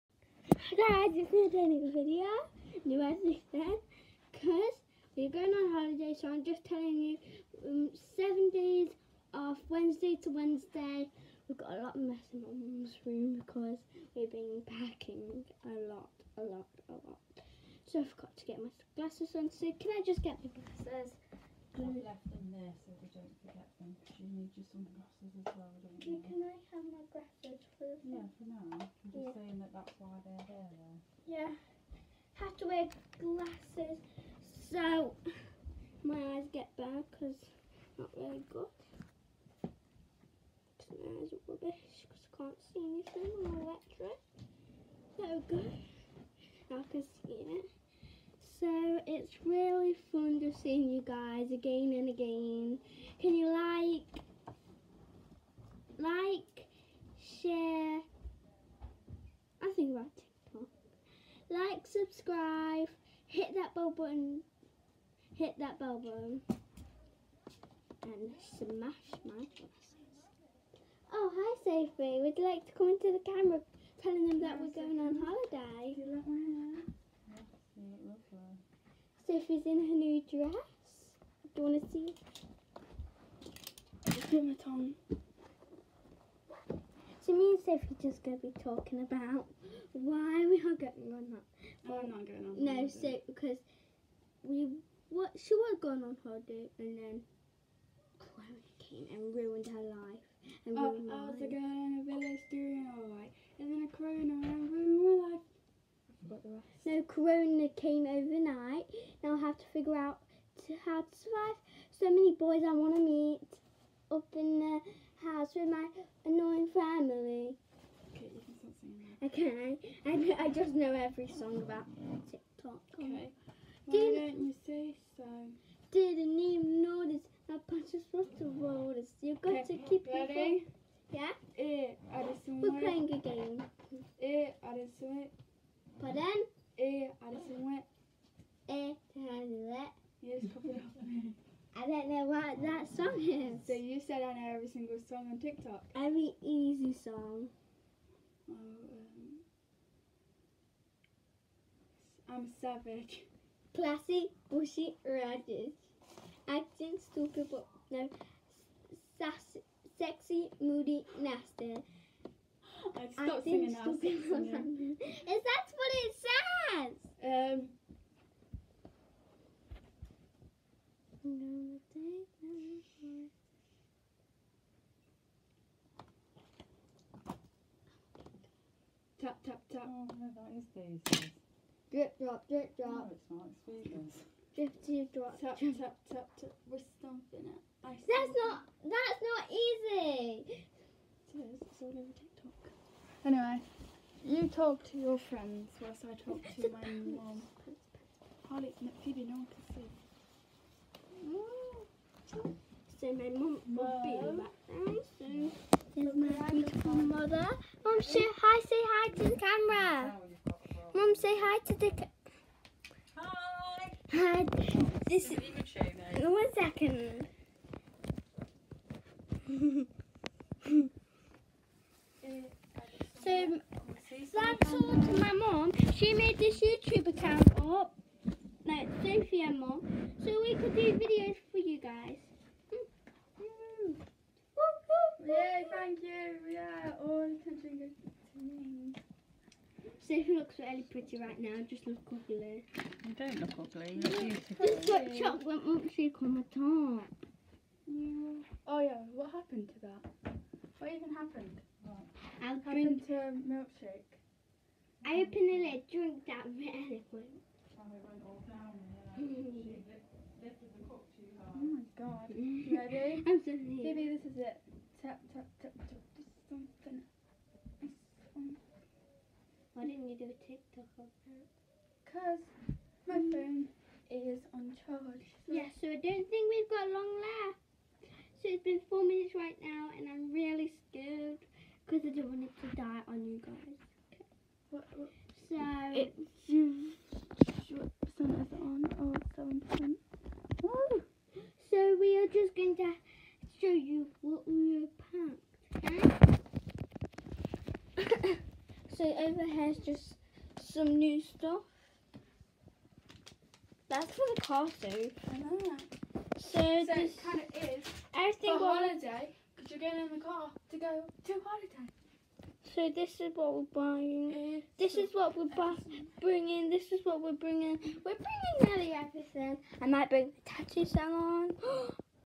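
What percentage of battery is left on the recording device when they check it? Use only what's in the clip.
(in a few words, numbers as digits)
7%.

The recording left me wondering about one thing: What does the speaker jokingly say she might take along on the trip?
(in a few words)
The tattoo salon.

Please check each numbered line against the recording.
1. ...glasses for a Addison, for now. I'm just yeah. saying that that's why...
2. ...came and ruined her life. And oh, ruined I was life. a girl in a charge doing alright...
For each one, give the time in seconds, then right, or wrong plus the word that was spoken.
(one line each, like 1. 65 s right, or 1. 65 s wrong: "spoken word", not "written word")
1. 27 s wrong: "Yeah", not "Addison"
2. 98 s wrong: "village", not "charge".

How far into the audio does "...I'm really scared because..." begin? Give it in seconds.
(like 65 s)
280 s.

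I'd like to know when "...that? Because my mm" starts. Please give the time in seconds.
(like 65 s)
271 s.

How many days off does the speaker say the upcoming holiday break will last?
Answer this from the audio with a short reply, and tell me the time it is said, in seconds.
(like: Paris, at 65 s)
7, at 8 s.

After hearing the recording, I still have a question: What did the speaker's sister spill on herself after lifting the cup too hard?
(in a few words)
Chocolate milkshake.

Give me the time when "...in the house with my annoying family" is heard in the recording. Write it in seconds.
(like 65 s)
114 s.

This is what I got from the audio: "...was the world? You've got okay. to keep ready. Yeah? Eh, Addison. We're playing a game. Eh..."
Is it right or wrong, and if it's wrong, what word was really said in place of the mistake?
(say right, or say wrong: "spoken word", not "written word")
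right.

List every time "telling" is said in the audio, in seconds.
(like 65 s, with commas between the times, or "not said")
6 s, 74 s.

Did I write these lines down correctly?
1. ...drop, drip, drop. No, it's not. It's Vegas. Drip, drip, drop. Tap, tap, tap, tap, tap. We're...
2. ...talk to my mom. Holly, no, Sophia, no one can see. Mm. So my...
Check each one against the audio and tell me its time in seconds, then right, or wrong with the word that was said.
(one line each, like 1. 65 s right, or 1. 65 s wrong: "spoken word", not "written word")
1. 182 s right
2. 196 s wrong: "Phoebe", not "Sophia".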